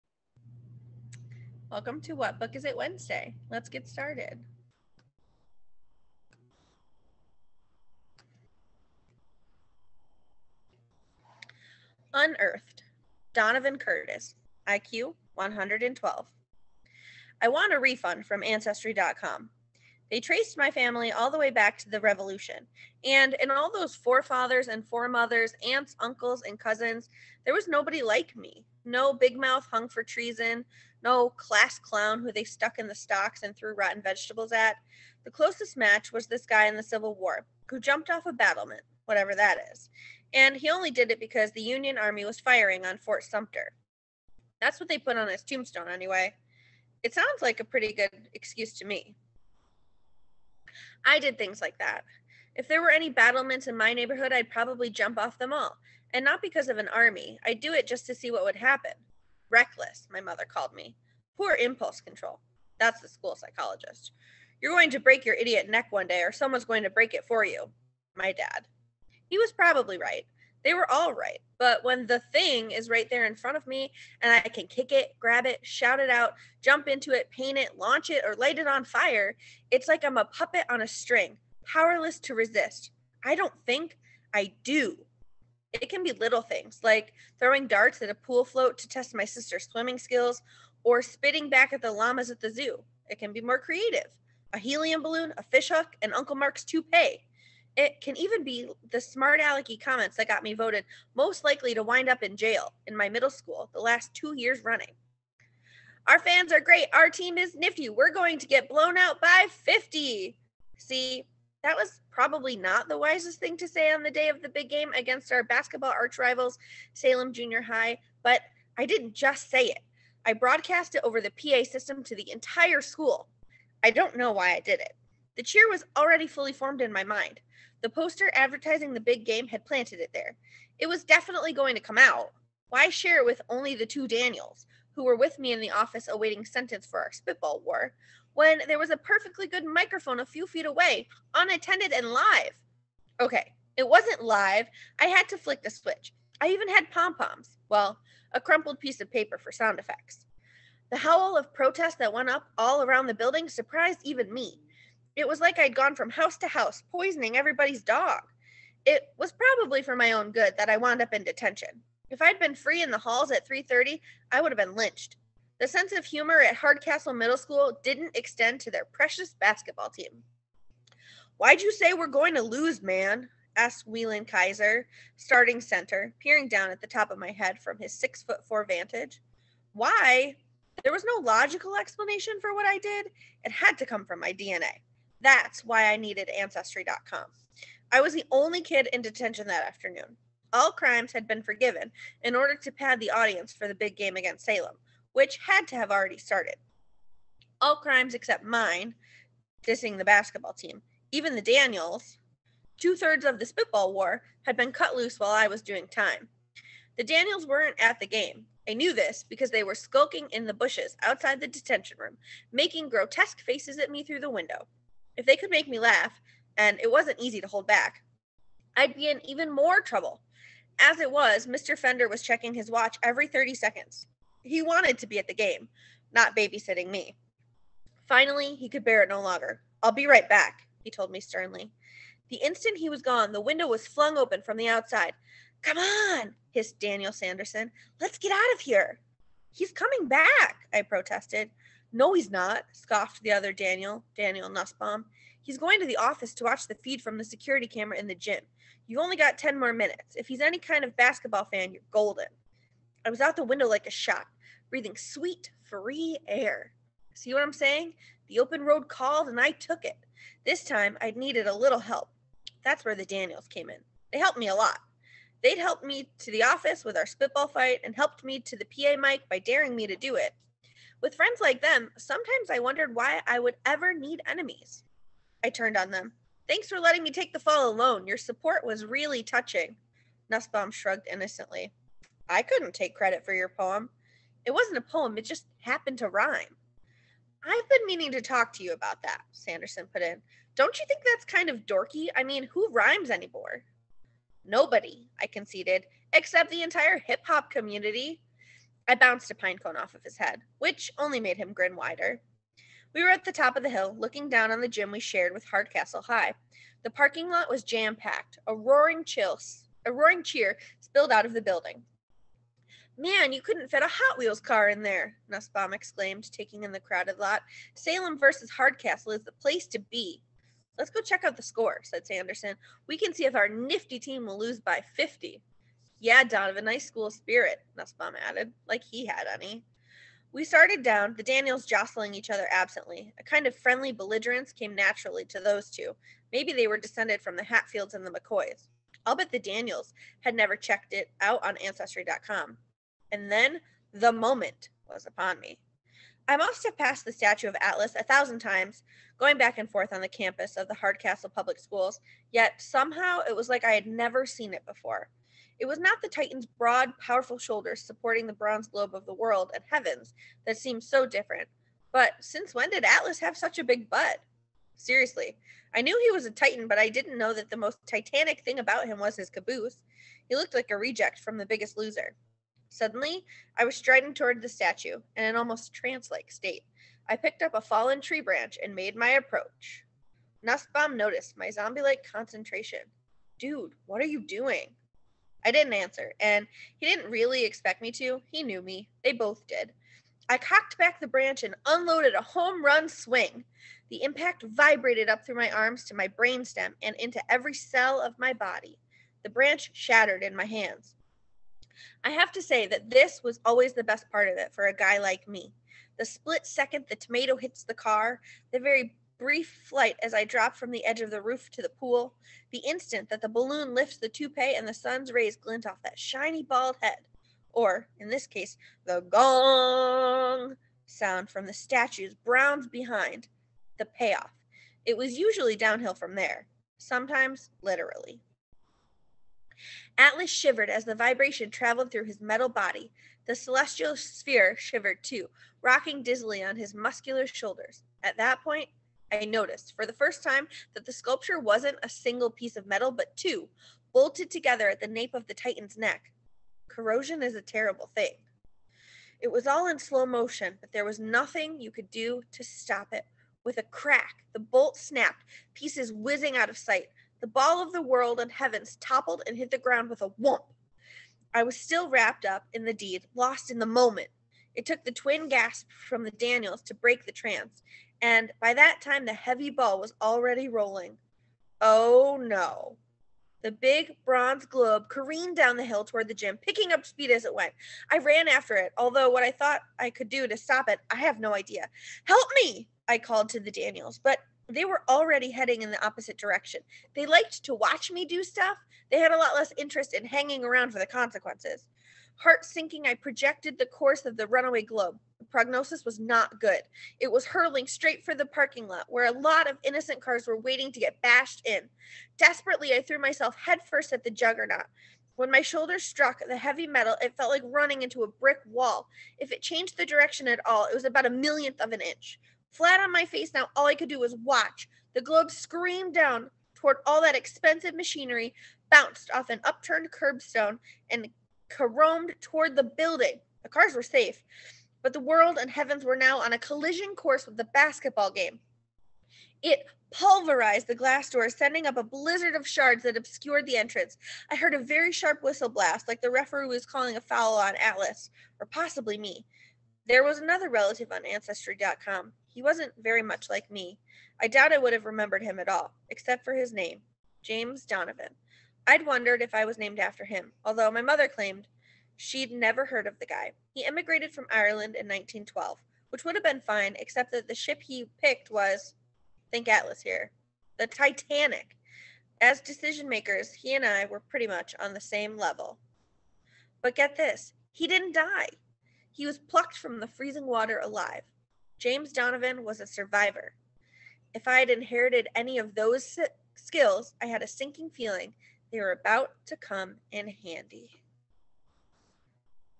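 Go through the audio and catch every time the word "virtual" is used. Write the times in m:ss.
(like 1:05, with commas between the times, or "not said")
not said.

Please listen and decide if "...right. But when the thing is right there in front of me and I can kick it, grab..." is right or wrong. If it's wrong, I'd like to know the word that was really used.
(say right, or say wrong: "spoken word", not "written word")
right.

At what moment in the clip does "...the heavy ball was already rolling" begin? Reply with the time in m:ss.
7:49.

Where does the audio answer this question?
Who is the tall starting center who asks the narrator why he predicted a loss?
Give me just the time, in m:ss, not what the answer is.
2:53.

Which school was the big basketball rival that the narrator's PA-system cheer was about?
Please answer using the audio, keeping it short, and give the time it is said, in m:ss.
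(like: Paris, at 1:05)
Salem Junior High, at 1:56.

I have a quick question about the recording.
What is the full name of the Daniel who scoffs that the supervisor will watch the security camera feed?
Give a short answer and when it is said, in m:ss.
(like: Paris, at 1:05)
Daniel Nussbaum, at 4:04.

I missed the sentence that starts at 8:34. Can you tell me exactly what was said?
The globe screamed down toward all that expensive machinery, bounced off an upturned curbstone, and caromed toward the building.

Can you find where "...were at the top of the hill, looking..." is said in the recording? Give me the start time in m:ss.
5:03.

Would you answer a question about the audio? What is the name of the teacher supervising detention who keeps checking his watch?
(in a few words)
Mr. Fender.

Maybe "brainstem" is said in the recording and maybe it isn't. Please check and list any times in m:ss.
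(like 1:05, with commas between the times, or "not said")
6:36.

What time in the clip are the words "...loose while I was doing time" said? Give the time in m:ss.
3:24.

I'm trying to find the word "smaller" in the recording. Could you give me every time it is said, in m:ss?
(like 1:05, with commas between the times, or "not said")
not said.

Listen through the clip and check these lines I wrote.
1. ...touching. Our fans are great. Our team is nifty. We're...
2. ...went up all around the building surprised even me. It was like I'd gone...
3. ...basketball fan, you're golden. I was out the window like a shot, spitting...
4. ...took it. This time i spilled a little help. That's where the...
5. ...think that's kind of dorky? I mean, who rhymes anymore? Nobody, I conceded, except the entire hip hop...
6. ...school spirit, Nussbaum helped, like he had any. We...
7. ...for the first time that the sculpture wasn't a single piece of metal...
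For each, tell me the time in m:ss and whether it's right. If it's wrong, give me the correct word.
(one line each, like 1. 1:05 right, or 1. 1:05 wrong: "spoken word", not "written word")
1. 1:44 wrong: "running", not "touching"
2. 2:32 right
3. 4:10 wrong: "breathing", not "spitting"
4. 4:19 wrong: "needed", not "spilled"
5. 4:50 right
6. 5:26 wrong: "added", not "helped"
7. 7:19 right.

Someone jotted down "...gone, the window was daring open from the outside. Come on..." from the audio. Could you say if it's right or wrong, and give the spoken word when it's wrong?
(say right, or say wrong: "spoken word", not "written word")
wrong: "flung", not "daring".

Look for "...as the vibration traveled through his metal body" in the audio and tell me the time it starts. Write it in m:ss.
7:10.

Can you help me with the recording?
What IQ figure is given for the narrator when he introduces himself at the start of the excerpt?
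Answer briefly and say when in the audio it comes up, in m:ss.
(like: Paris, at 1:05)
112, at 0:14.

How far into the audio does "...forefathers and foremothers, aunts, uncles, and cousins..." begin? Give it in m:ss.
0:23.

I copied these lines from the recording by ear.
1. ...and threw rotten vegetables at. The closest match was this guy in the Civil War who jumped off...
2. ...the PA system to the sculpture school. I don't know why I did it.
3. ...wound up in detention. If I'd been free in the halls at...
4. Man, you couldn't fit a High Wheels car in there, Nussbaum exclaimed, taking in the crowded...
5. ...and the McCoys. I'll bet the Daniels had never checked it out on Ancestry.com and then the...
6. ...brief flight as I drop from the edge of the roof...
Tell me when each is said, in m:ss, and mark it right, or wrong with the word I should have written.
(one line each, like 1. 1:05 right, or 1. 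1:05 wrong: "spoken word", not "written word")
1. 0:33 right
2. 2:01 wrong: "entire", not "sculpture"
3. 2:40 right
4. 5:13 wrong: "Hot", not "High"
5. 5:37 right
6. 6:49 right.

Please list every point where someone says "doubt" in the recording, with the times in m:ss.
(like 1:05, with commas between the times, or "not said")
9:04.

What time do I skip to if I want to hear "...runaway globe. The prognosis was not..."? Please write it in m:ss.
8:14.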